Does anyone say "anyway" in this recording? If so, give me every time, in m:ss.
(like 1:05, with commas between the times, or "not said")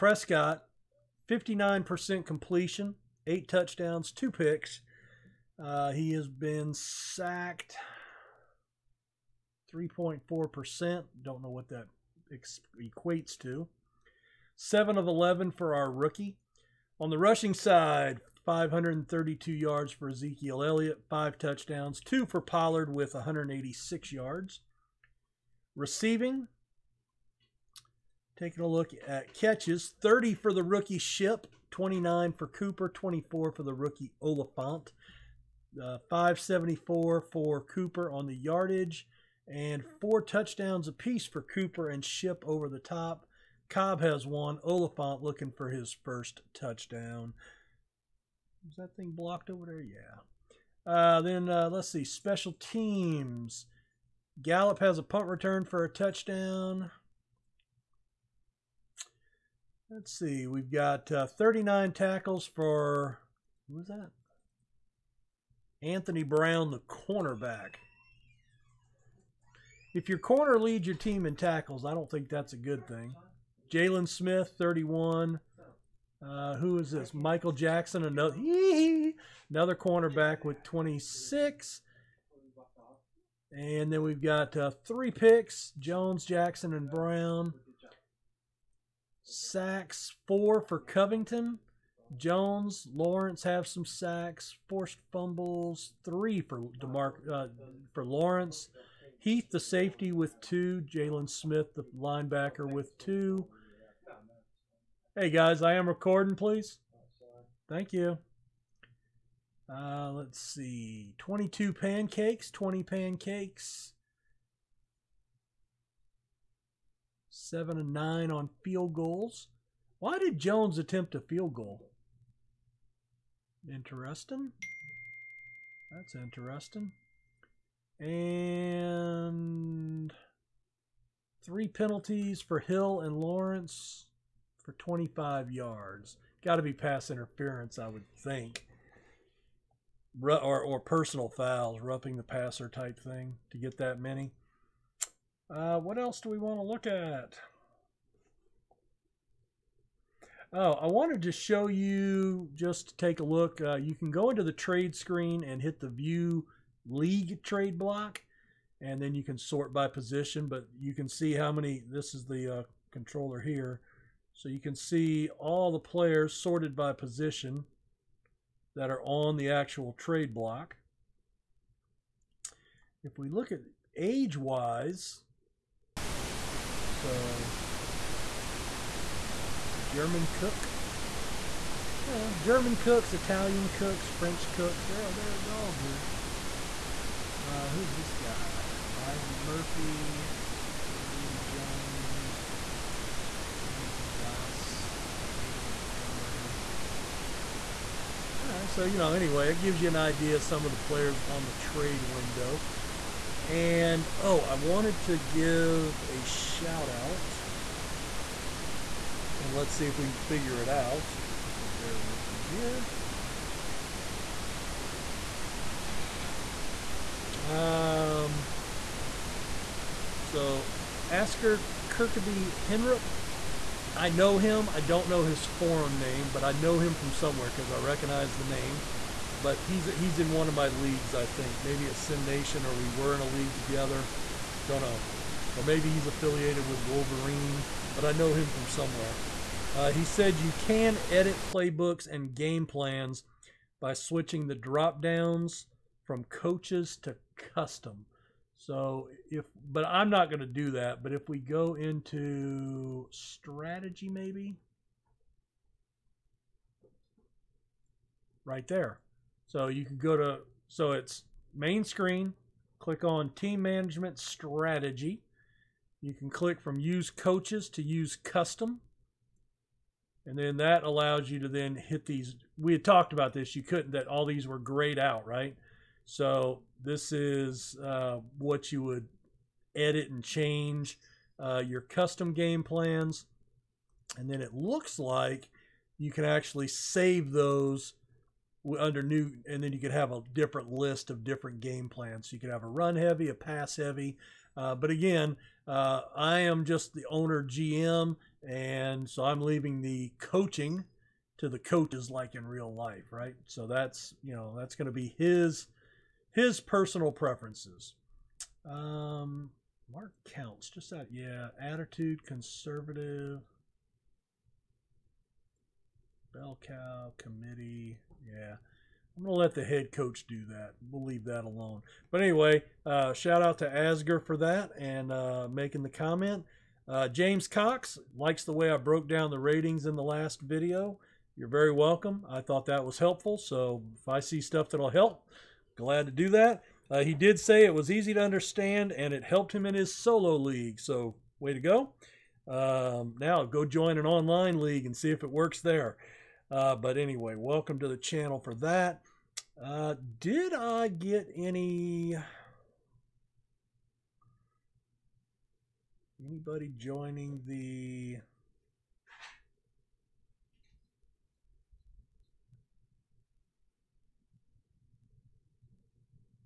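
3:19, 5:22, 5:46.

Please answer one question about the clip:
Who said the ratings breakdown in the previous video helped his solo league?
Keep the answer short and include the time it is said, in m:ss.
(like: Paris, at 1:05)
James Cox, at 5:27.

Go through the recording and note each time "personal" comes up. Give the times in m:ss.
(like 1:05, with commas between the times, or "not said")
2:20, 5:06.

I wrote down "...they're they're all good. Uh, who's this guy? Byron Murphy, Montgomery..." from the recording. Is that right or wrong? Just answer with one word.
wrong.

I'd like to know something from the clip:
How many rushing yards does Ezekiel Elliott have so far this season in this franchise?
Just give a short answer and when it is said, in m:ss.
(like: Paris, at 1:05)
532, at 0:18.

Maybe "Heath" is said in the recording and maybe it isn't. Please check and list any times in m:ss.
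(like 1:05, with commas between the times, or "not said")
1:39.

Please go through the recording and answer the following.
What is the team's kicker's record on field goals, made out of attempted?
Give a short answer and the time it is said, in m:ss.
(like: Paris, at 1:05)
7 of 9, at 1:57.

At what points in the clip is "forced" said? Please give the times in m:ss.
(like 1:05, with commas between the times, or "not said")
1:34.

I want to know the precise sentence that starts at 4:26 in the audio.
You can click from use coaches to use custom.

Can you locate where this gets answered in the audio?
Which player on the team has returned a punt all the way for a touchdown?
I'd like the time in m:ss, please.
0:54.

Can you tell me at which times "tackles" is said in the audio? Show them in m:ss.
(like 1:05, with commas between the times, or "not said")
1:01, 1:11.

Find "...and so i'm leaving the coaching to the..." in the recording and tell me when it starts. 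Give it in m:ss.
4:58.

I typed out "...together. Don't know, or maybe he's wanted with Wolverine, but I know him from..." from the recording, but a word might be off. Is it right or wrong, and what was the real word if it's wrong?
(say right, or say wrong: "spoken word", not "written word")
wrong: "affiliated", not "wanted".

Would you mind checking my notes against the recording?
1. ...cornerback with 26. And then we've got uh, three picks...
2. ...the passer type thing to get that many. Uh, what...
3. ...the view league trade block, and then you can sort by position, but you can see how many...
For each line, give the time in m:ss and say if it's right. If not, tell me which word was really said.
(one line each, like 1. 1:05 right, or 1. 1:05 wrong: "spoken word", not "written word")
1. 1:19 right
2. 2:22 right
3. 2:35 right.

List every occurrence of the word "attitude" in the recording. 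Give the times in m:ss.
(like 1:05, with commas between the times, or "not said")
5:11.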